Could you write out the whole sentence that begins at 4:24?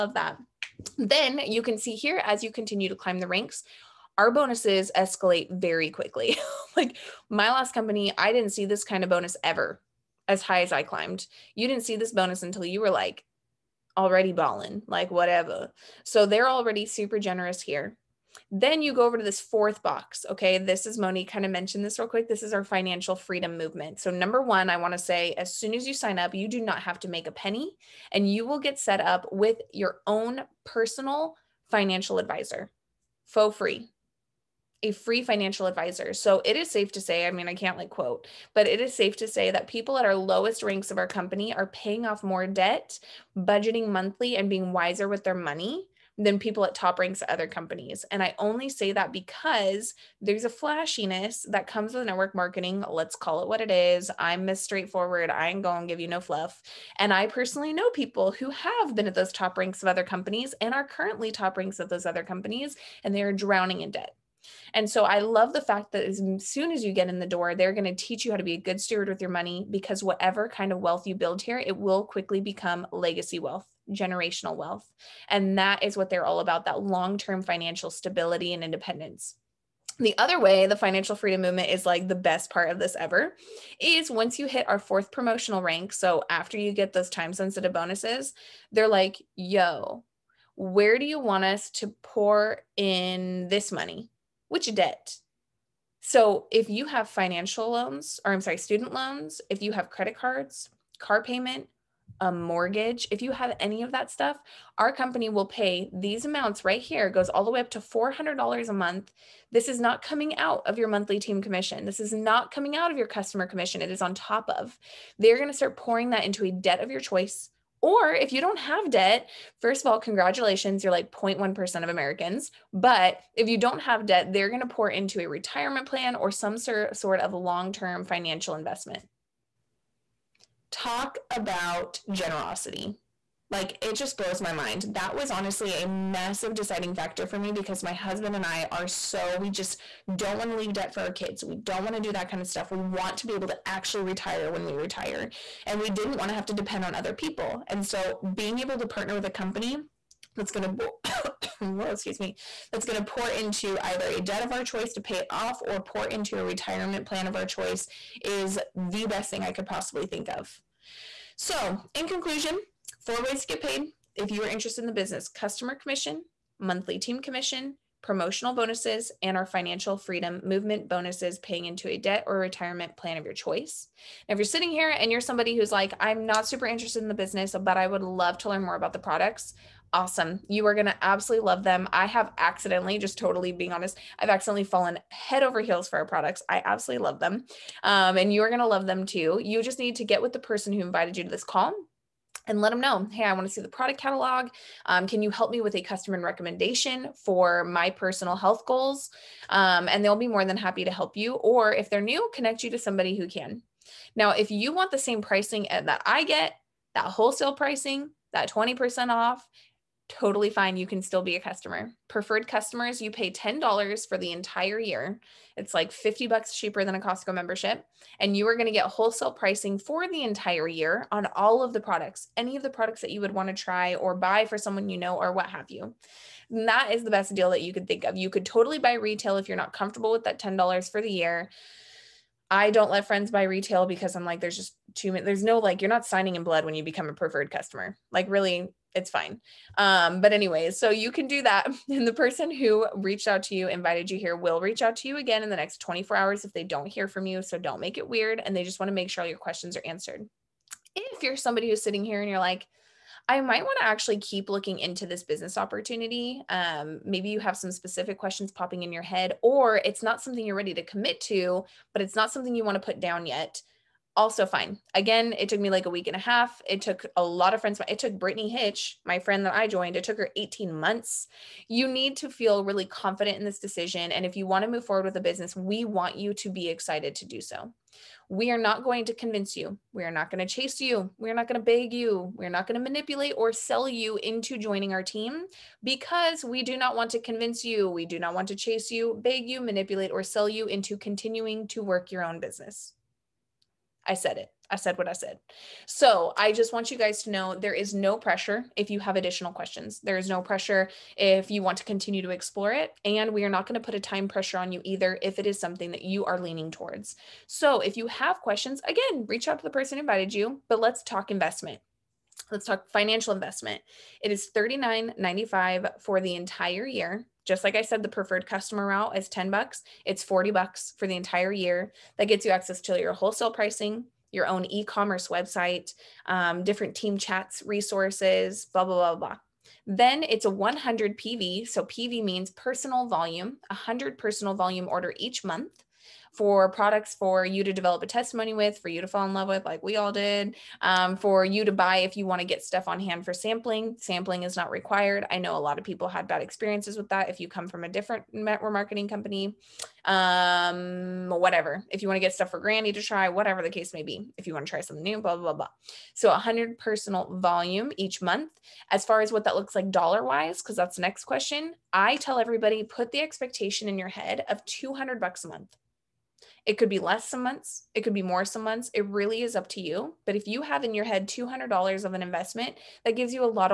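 Again, it took me like a week and a half.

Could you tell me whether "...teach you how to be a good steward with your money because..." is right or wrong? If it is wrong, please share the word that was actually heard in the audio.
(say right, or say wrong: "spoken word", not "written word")
right.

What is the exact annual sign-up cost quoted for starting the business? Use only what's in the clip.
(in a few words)
$39.95.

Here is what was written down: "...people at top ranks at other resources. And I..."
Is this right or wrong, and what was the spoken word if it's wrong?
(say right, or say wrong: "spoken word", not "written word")
wrong: "companies", not "resources".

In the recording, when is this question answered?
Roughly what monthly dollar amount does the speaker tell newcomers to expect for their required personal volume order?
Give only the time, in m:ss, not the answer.
6:04.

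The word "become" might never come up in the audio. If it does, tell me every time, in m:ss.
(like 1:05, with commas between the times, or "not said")
1:12, 3:56.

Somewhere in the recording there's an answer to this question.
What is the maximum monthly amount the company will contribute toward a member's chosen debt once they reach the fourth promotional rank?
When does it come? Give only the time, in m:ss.
1:47.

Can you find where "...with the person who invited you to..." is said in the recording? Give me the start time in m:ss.
3:10.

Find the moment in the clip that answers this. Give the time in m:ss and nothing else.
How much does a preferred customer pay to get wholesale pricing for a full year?
3:33.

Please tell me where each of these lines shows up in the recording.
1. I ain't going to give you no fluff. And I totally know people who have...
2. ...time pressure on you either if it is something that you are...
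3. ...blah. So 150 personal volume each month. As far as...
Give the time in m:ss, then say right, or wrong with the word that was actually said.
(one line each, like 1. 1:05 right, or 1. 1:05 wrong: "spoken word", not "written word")
1. 0:55 wrong: "personally", not "totally"
2. 5:04 right
3. 5:55 wrong: "100", not "150".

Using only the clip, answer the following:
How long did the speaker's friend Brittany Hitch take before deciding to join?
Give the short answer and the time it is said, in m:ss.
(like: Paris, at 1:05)
18 months, at 4:30.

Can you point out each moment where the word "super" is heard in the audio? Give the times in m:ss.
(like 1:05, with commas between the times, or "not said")
0:16, 2:56.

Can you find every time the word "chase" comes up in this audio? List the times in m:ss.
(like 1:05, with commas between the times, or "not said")
4:40, 4:48.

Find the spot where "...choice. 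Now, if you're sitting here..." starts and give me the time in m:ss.
2:53.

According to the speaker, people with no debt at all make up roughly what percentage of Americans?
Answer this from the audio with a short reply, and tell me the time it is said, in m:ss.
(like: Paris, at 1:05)
0.1%, at 2:01.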